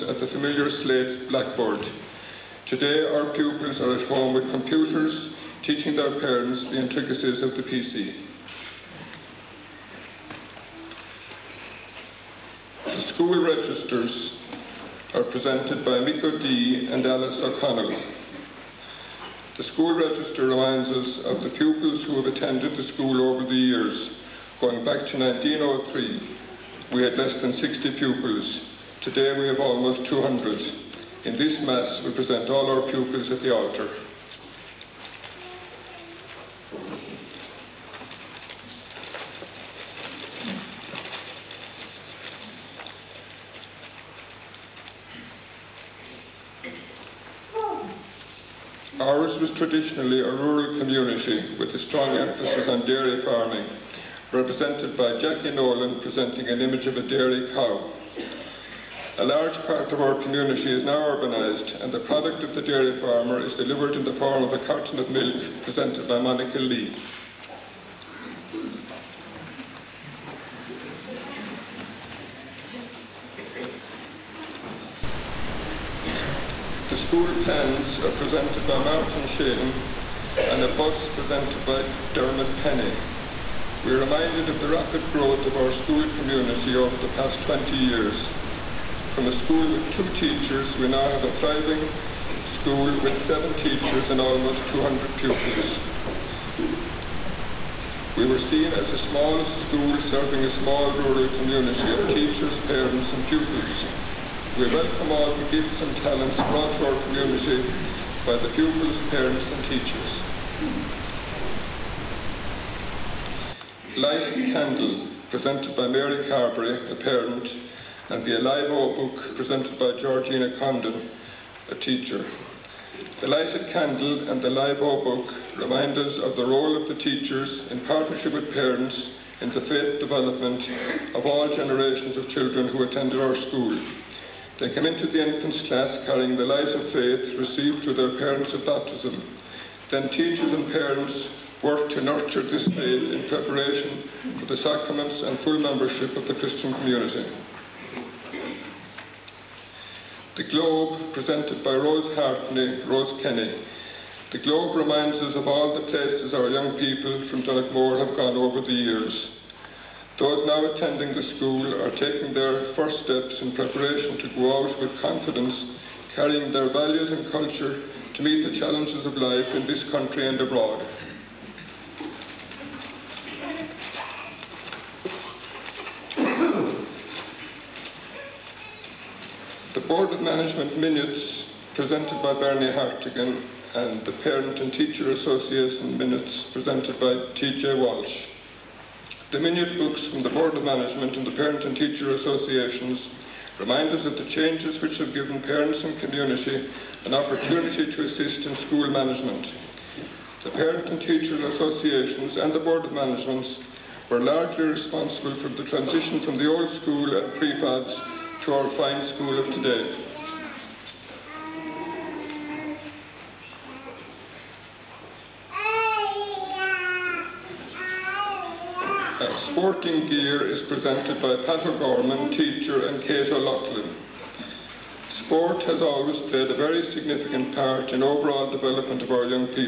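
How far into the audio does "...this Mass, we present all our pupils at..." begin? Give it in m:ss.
0:31.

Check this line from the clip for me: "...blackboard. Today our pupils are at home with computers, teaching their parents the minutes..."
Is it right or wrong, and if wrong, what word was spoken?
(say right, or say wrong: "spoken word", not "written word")
wrong: "intricacies", not "minutes".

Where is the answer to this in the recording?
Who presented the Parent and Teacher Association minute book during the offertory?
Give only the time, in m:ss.
3:07.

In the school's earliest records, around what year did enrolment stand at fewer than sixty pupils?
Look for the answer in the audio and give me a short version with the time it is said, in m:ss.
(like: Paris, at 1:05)
1903, at 0:25.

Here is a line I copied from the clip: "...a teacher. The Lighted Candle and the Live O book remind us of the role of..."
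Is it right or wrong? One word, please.
right.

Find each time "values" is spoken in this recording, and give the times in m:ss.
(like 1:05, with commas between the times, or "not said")
2:46.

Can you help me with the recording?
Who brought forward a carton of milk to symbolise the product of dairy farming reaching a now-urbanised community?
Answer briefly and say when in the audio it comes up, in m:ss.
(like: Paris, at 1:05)
Monica Lee, at 1:06.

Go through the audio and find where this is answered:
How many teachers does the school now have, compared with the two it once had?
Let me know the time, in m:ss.
1:33.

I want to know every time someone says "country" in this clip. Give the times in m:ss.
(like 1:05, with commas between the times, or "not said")
2:49.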